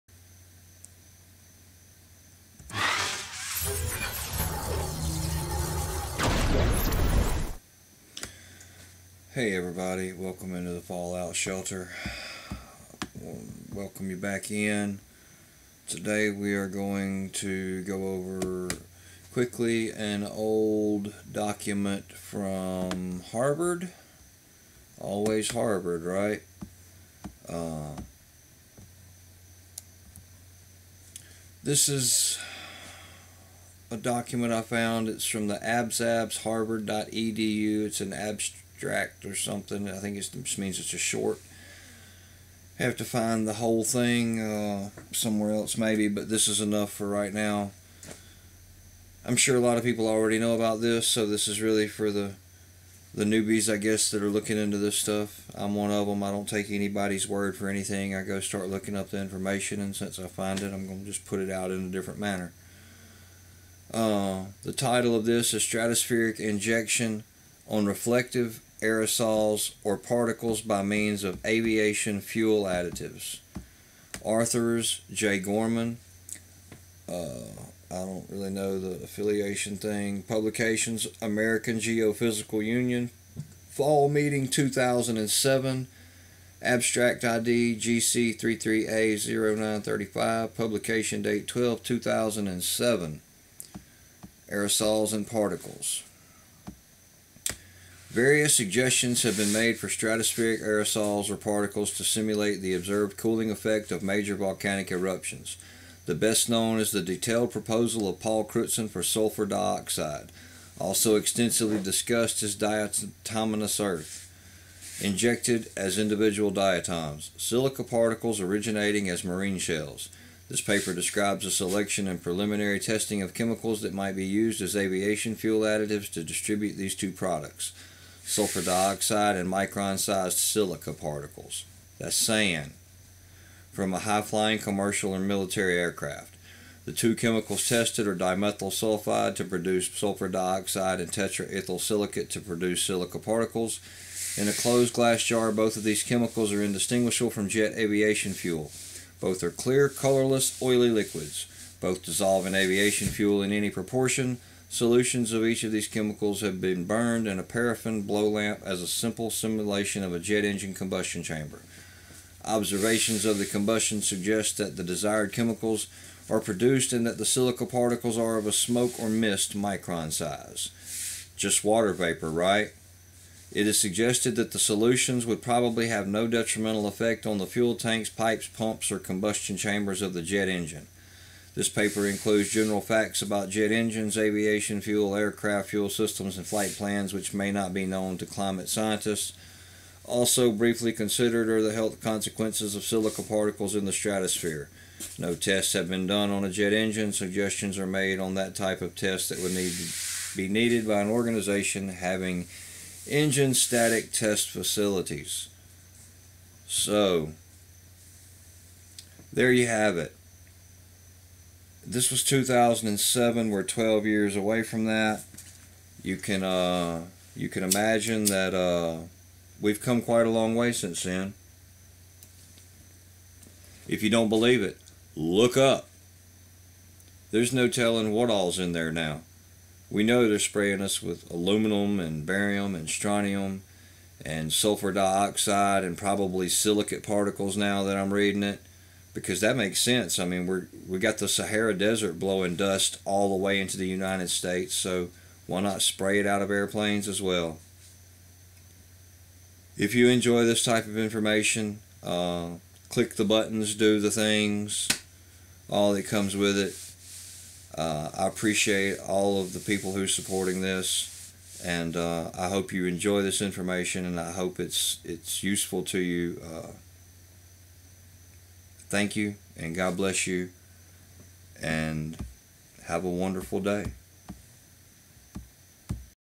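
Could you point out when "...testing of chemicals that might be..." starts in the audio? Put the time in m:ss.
2:02.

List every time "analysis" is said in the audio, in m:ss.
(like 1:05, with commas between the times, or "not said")
not said.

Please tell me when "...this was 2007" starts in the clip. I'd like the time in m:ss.
3:31.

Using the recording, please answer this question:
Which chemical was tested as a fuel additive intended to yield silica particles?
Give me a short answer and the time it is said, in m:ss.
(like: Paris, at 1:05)
Tetraethyl silicate, at 2:21.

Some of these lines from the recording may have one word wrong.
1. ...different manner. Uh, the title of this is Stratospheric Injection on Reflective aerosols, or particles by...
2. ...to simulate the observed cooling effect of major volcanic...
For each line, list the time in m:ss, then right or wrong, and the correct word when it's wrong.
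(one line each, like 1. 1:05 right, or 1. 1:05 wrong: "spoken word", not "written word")
1. 1:01 right
2. 1:41 right.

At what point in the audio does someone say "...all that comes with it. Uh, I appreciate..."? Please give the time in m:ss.
4:15.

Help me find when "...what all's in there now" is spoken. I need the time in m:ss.
3:48.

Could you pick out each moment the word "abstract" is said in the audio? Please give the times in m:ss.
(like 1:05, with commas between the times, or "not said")
0:38, 1:26.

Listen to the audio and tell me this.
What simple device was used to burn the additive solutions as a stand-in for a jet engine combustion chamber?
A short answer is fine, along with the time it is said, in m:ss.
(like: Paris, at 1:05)
Paraffin blow lamp, at 2:37.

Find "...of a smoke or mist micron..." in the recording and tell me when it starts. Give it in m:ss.
2:48.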